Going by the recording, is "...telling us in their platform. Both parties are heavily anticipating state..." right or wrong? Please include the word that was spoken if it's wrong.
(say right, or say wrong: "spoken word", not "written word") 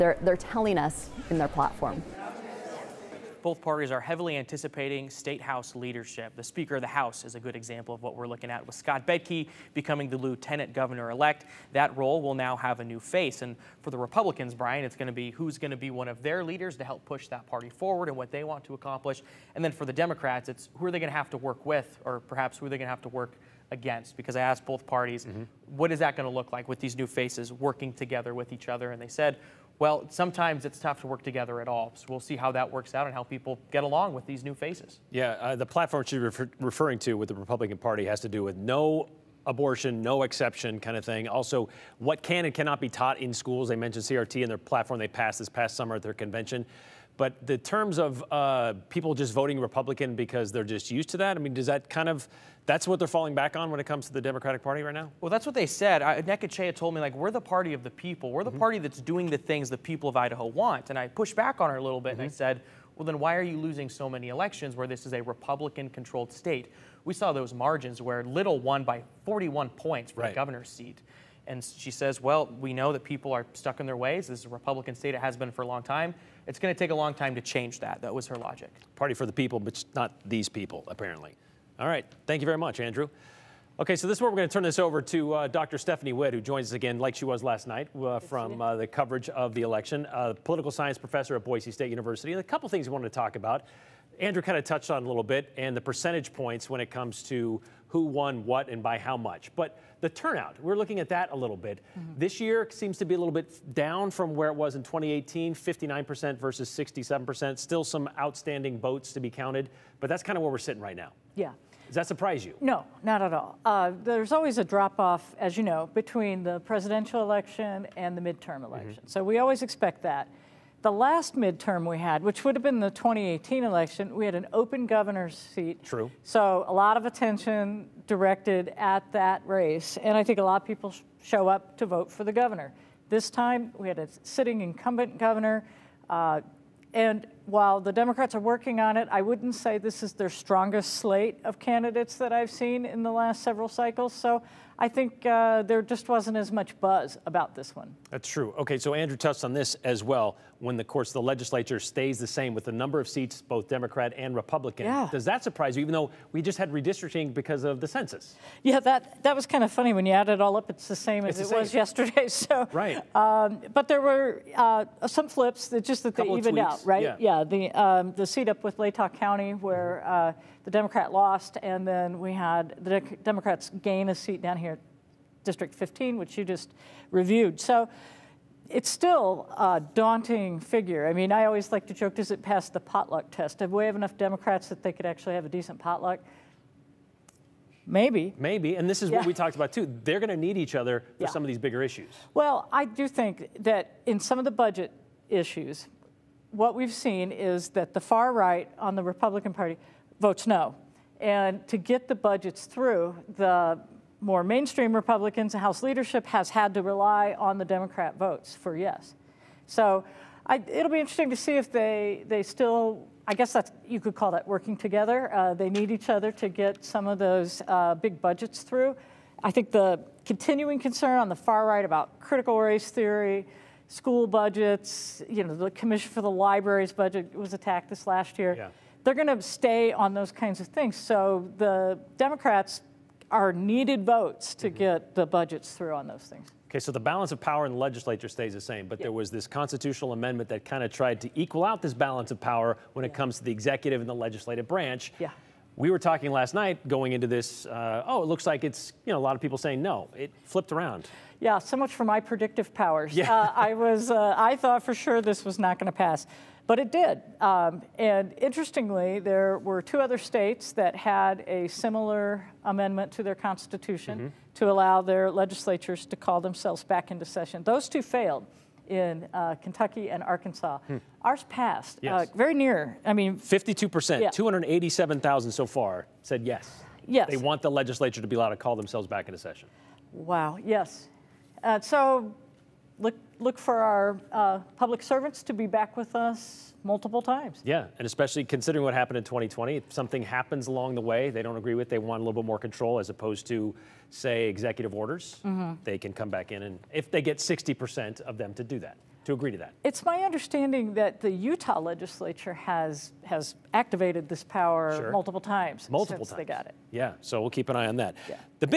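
right.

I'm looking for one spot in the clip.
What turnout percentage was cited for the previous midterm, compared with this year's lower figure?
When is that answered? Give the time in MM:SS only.
01:46.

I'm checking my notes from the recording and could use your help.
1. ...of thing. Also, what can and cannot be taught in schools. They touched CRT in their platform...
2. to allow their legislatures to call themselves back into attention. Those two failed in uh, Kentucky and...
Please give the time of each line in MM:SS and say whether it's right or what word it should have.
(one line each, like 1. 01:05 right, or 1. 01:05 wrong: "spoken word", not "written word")
1. 00:40 wrong: "mentioned", not "touched"
2. 04:24 wrong: "session", not "attention".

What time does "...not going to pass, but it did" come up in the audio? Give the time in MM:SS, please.
04:15.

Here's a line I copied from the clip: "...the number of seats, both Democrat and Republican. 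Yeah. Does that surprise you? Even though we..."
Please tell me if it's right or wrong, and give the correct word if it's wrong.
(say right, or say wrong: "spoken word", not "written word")
right.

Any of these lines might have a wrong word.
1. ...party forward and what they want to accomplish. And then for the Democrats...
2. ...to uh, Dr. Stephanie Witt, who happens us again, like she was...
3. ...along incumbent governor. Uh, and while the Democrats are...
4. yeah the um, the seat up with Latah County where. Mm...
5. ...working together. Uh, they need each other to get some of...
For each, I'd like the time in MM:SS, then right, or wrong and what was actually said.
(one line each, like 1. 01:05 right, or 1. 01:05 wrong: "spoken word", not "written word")
1. 00:17 right
2. 01:25 wrong: "joins", not "happens"
3. 02:14 wrong: "sitting", not "along"
4. 02:47 right
5. 03:34 right.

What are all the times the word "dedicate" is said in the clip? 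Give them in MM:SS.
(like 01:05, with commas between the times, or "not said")
not said.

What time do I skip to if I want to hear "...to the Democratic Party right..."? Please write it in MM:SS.
00:54.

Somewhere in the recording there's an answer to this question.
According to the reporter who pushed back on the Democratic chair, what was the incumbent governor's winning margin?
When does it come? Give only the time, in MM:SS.
01:09.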